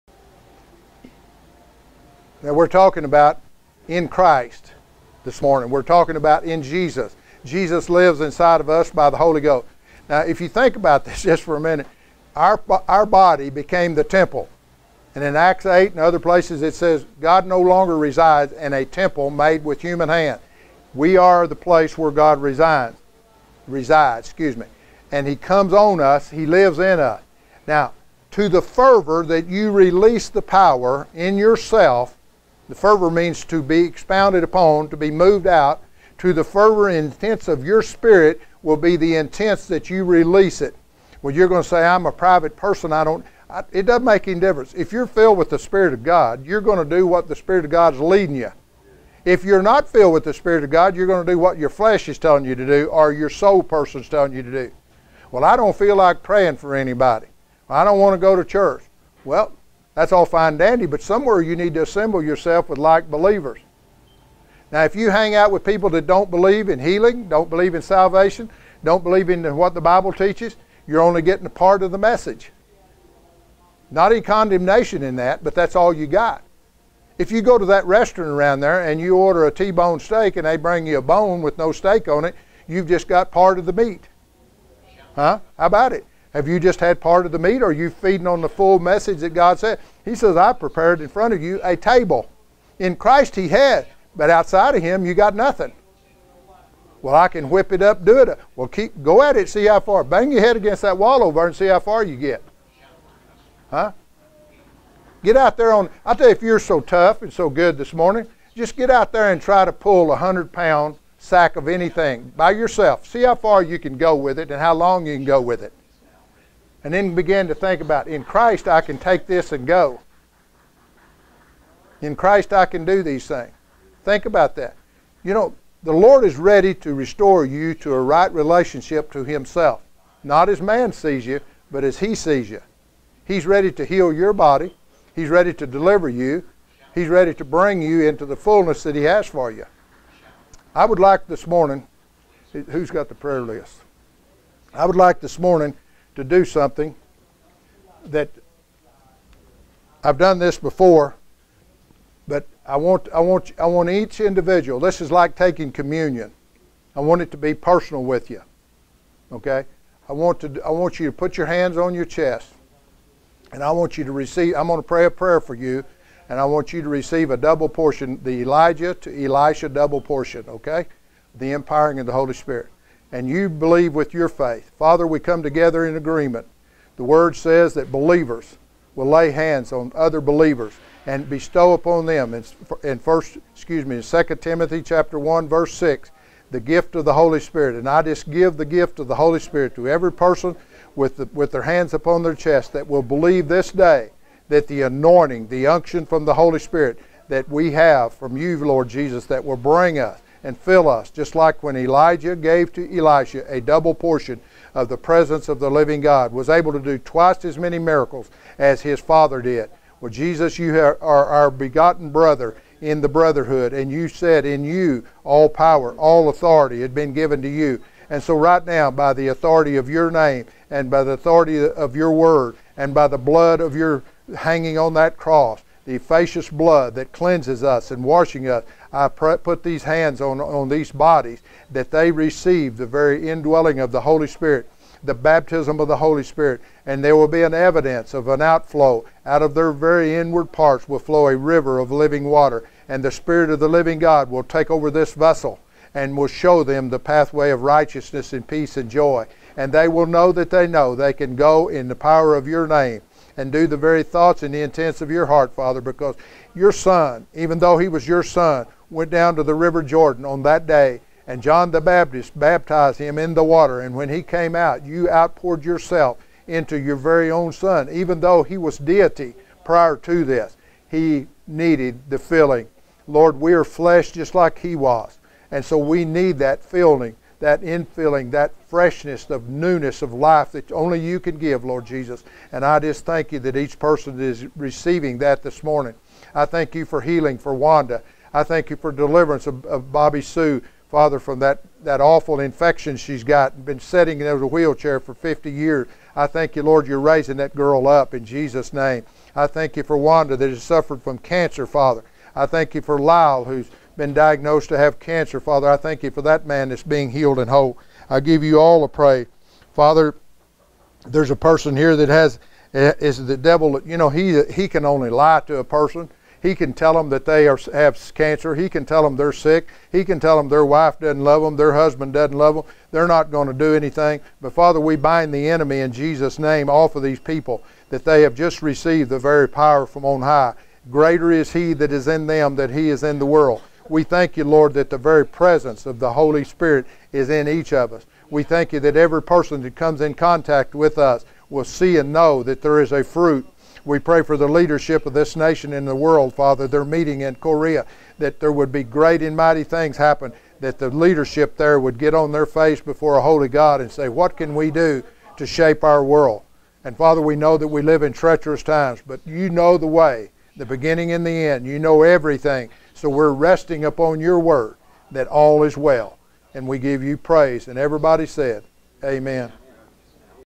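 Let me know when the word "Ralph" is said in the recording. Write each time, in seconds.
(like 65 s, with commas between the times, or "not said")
not said.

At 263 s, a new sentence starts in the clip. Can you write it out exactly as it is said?
And when he came out, you outpoured yourself into your very own son, even though he was deity prior to this.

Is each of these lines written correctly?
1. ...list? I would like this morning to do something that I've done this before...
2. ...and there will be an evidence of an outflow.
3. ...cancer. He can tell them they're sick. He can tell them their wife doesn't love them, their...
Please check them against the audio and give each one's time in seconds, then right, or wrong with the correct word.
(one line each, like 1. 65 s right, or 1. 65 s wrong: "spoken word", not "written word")
1. 143 s right
2. 236 s right
3. 318 s right.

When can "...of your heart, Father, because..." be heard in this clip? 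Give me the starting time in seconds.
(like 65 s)
255 s.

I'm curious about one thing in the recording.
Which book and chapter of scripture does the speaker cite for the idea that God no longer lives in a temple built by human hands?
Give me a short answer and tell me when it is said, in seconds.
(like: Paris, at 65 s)
Acts 8, at 15 s.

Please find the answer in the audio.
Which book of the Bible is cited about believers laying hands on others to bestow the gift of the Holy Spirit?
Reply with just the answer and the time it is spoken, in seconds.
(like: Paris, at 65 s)
2 Timothy, at 184 s.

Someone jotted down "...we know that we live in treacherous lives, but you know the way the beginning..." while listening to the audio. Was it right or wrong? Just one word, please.
wrong.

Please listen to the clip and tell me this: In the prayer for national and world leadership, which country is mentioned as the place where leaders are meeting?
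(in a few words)
Korea.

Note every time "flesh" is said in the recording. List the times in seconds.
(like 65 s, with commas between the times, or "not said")
51 s, 273 s.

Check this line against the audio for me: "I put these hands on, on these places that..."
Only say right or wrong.
wrong.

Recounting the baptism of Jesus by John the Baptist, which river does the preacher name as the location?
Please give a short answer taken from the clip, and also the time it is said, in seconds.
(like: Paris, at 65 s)
River Jordan, at 259 s.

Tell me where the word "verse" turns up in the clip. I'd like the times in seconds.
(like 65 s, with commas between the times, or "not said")
185 s.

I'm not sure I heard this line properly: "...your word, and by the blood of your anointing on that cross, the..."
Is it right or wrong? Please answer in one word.
wrong.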